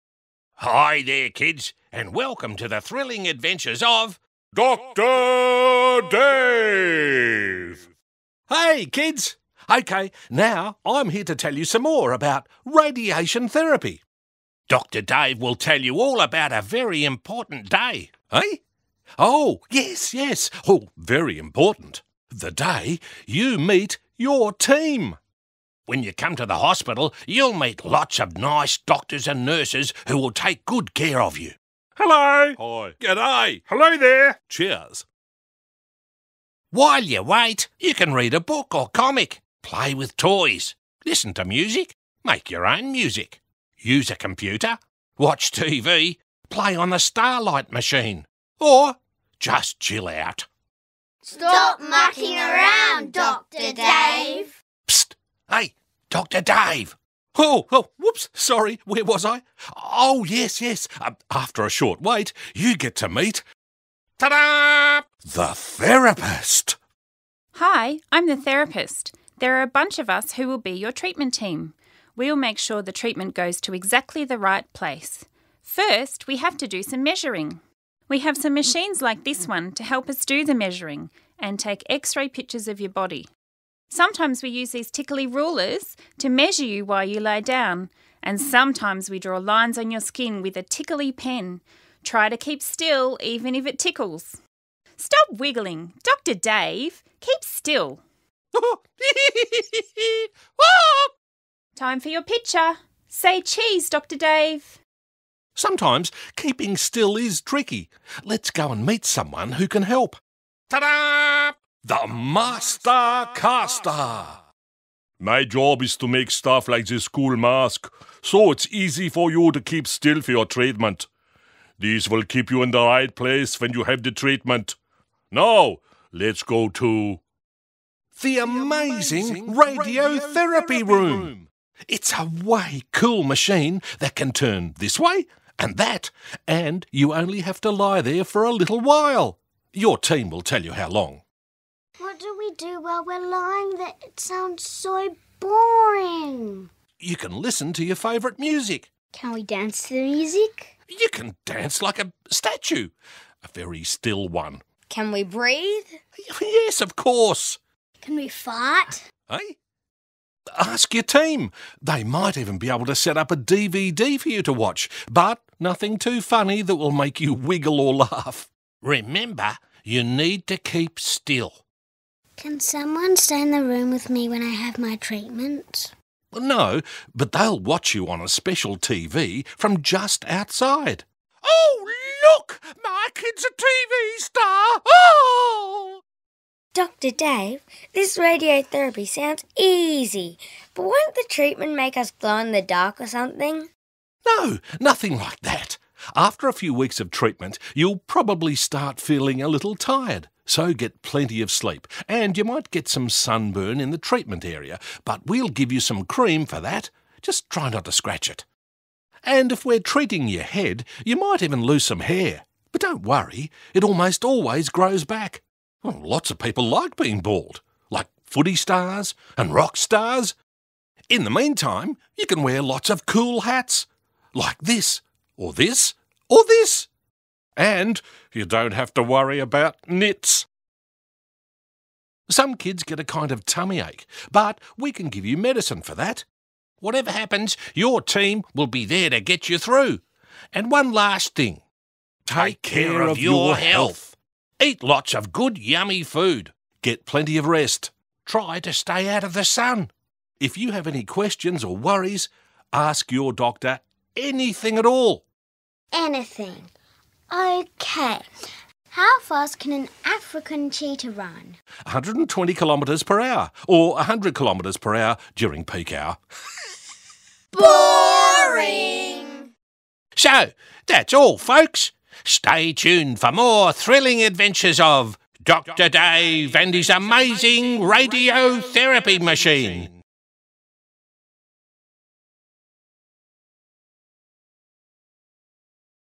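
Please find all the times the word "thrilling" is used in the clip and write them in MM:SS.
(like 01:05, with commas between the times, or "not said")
00:02, 04:33.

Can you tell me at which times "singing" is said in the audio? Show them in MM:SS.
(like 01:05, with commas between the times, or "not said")
not said.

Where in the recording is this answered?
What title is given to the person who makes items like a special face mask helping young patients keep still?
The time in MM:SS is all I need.
01:51.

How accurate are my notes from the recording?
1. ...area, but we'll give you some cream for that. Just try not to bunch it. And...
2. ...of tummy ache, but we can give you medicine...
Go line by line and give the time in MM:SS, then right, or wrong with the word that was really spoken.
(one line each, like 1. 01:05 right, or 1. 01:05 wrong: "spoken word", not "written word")
1. 03:24 wrong: "scratch", not "bunch"
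2. 03:53 right.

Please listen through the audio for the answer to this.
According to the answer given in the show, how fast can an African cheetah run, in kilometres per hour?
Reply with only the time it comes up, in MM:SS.
04:21.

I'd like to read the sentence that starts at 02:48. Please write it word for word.
Remember, you need to keep still.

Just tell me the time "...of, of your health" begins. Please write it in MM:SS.
04:03.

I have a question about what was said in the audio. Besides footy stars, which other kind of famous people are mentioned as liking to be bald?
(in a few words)
Rock stars.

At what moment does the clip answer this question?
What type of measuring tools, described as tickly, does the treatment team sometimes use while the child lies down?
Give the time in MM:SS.
01:24.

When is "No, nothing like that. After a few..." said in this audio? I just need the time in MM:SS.
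03:14.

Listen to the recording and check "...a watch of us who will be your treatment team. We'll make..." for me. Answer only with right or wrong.
wrong.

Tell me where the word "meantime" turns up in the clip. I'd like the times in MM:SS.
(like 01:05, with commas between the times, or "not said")
03:41.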